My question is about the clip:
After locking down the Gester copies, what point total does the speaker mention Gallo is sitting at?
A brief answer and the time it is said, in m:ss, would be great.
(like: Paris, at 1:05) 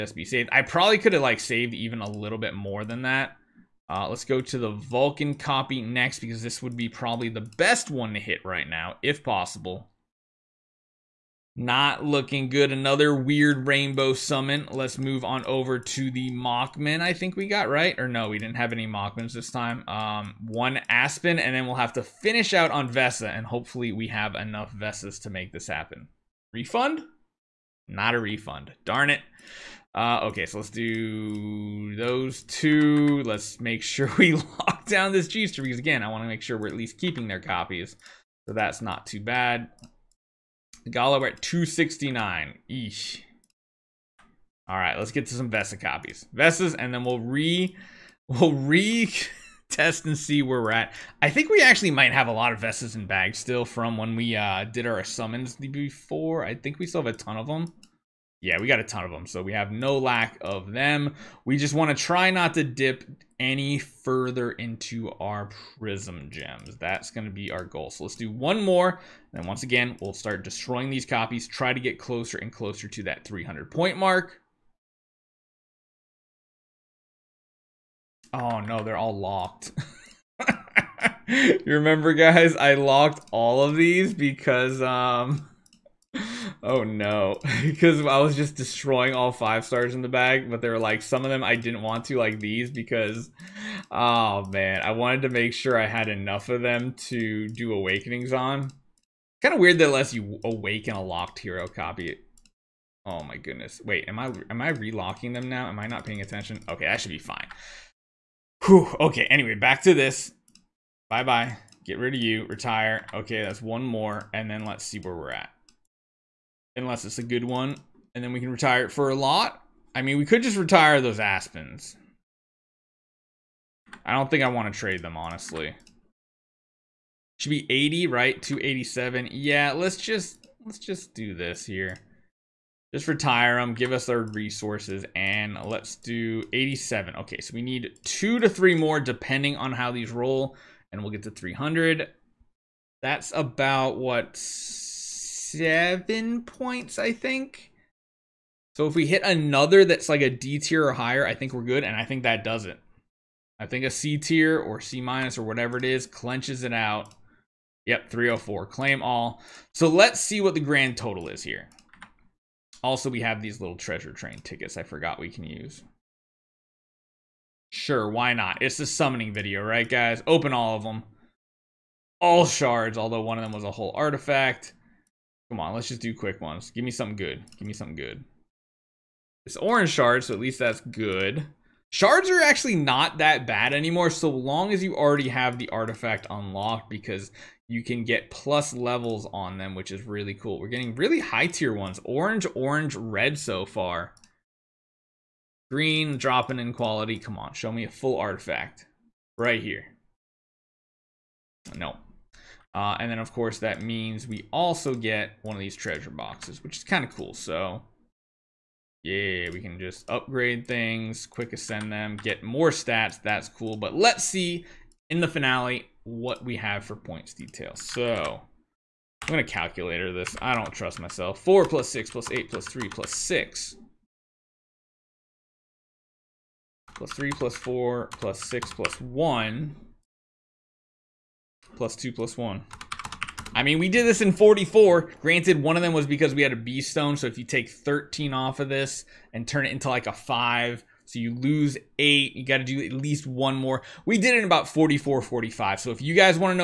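269, at 0:41.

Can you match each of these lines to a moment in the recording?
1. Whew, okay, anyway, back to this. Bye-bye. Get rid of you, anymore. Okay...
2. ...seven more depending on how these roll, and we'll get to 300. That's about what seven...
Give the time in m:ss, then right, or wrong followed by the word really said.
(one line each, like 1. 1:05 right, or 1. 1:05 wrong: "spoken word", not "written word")
1. 1:48 wrong: "retire", not "anymore"
2. 2:18 wrong: "three", not "seven".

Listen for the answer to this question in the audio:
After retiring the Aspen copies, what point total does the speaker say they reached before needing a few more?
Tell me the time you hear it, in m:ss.
2:08.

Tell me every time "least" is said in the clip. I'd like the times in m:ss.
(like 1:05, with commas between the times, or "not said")
0:36, 3:00, 4:02.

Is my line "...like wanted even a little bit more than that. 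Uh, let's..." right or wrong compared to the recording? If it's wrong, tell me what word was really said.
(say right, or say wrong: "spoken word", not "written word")
wrong: "saved", not "wanted".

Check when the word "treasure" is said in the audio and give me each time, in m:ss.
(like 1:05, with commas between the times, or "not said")
2:43, 3:25.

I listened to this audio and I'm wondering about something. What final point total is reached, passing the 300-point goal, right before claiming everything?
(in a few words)
304.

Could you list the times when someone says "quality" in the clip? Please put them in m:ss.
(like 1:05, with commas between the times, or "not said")
3:16.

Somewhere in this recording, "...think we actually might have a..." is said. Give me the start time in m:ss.
0:51.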